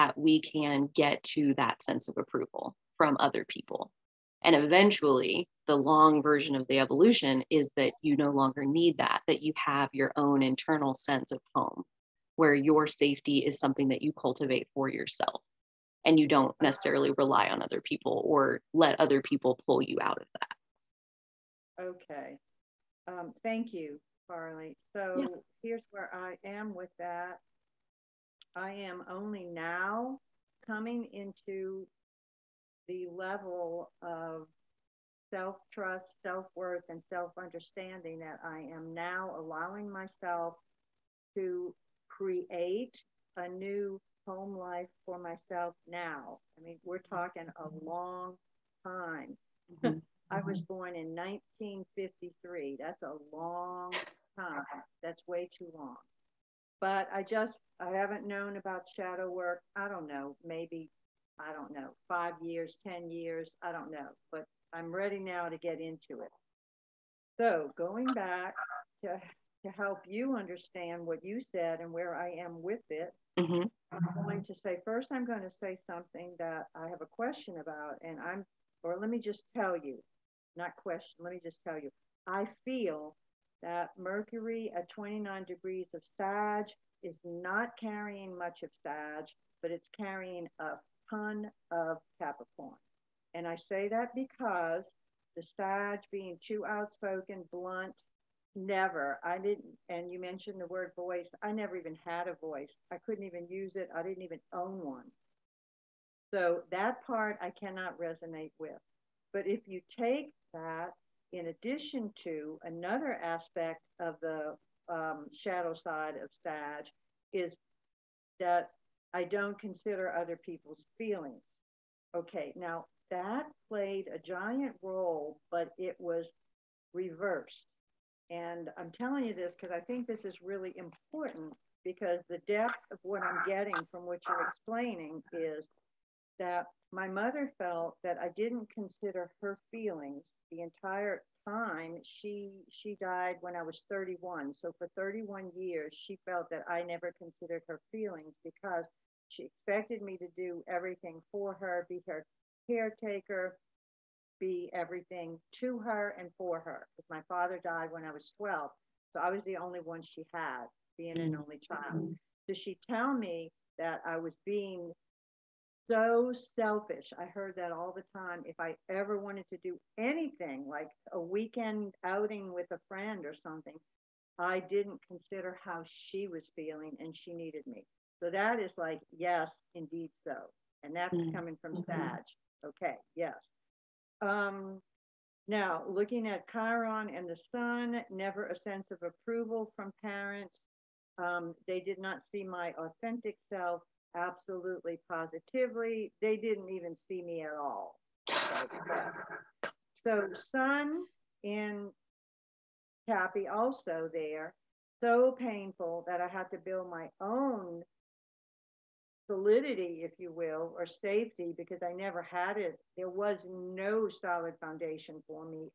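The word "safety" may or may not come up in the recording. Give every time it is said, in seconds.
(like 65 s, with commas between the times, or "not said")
12 s, 210 s.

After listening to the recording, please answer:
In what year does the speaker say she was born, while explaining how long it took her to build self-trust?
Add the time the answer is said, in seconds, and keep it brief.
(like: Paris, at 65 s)
1953, at 51 s.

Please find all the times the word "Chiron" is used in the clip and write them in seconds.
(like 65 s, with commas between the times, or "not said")
186 s.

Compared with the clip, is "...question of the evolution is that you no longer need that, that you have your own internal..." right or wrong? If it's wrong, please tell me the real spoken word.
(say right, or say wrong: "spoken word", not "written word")
wrong: "version", not "question".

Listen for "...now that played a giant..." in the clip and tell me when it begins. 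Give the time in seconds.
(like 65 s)
122 s.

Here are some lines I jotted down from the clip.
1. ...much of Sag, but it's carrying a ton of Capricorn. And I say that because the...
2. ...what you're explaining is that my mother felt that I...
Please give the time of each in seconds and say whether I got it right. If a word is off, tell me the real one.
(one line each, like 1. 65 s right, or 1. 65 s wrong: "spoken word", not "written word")
1. 88 s right
2. 134 s right.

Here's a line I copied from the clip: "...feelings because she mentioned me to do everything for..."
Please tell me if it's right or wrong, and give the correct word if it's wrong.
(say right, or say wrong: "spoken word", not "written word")
wrong: "expected", not "mentioned".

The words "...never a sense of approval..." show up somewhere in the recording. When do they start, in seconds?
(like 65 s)
188 s.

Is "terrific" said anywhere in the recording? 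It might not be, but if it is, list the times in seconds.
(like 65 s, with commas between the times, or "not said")
not said.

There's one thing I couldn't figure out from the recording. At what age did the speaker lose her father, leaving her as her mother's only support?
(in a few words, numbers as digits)
12.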